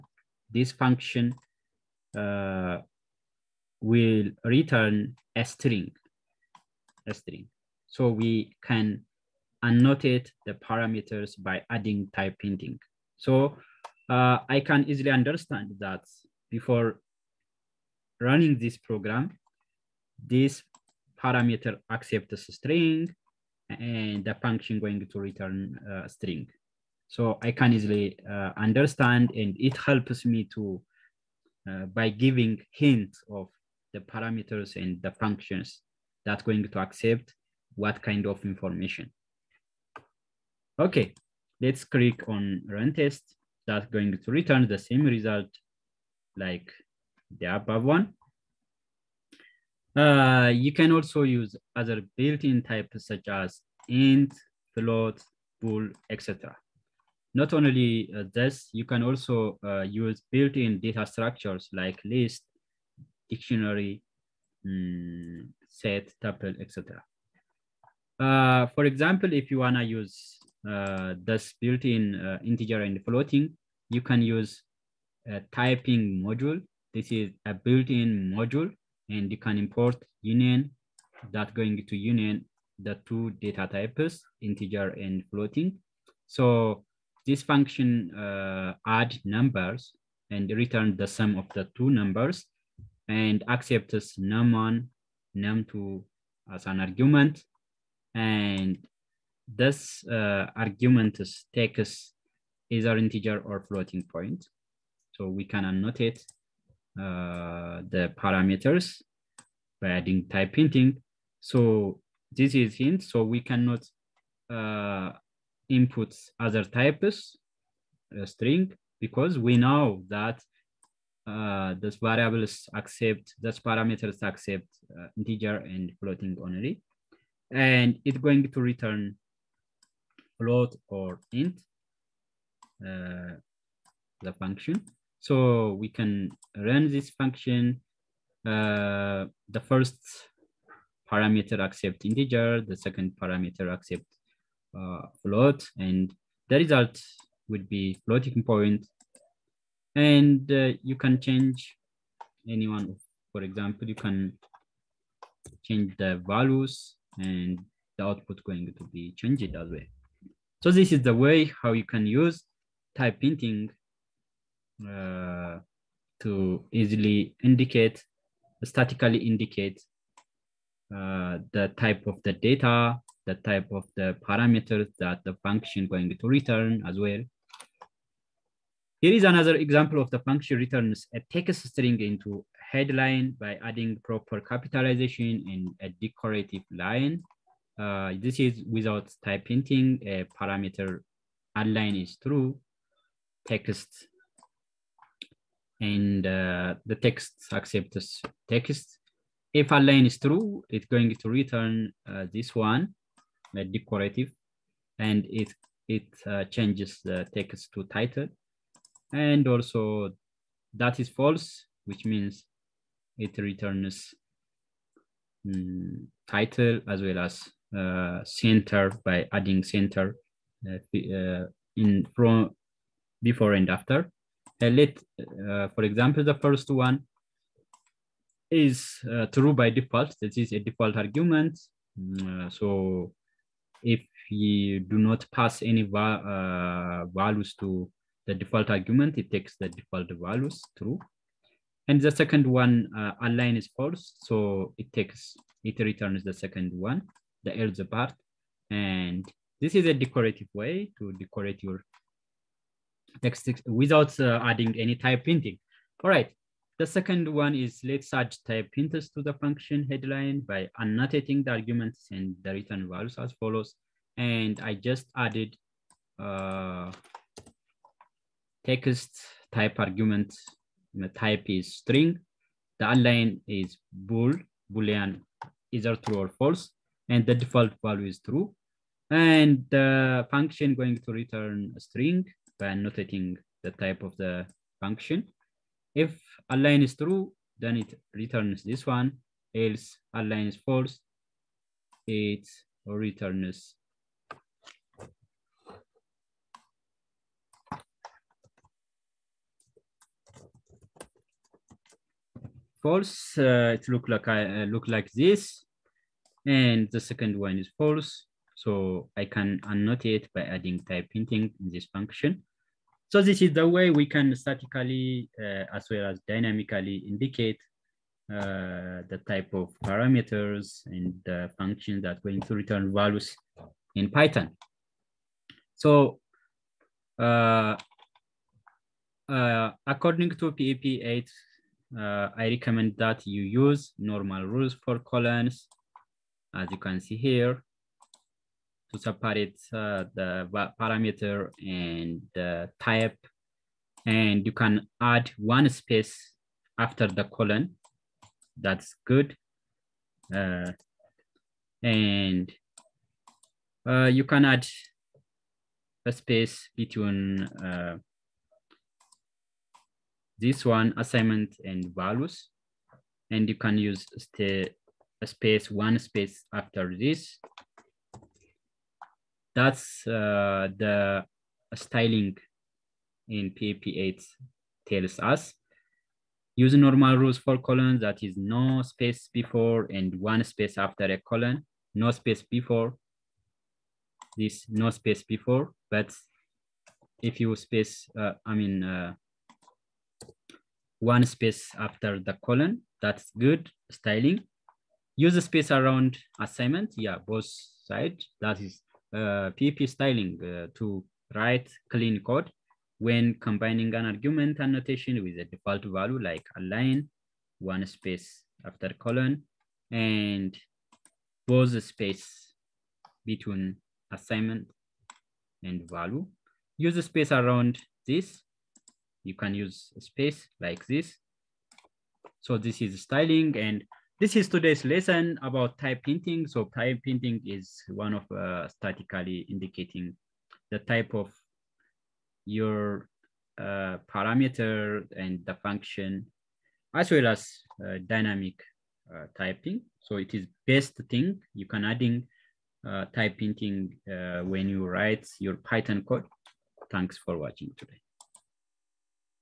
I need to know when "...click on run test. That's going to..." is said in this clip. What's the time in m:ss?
0:41.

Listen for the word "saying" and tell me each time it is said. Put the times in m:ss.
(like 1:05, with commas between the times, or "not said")
not said.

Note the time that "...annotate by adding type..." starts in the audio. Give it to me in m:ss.
5:09.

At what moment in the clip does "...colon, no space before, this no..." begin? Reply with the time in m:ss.
6:21.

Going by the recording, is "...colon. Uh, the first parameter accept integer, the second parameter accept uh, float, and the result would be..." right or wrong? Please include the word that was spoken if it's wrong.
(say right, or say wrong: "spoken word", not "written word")
wrong: "function", not "colon".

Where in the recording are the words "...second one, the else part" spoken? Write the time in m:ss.
4:06.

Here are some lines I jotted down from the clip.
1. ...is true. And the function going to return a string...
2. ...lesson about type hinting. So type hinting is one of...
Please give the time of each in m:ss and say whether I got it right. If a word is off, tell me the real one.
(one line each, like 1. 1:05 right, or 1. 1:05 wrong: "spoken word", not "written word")
1. 4:38 right
2. 7:04 right.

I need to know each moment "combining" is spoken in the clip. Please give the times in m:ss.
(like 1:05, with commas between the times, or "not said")
6:43.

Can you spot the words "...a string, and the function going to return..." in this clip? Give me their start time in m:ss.
0:22.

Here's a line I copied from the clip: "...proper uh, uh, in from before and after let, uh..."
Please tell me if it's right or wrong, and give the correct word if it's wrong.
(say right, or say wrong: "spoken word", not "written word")
wrong: "center", not "proper".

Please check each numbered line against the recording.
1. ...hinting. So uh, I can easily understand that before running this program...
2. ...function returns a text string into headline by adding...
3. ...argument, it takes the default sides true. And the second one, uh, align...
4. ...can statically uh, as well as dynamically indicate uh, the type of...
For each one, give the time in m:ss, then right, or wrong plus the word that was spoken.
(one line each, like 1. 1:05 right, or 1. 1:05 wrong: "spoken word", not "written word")
1. 0:12 right
2. 3:00 right
3. 3:58 wrong: "values", not "sides"
4. 5:14 right.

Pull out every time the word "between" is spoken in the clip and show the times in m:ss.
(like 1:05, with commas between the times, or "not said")
5:56, 6:53.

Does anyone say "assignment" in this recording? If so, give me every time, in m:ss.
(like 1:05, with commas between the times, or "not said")
6:00, 6:36, 6:54.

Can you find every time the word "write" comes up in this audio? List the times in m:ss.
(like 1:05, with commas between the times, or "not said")
6:41, 7:24.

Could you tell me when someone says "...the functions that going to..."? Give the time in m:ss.
0:35.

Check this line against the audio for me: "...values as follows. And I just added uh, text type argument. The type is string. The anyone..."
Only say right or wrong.
wrong.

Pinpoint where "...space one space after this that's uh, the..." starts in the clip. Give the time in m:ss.
6:05.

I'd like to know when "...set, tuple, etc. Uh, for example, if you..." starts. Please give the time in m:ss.
1:05.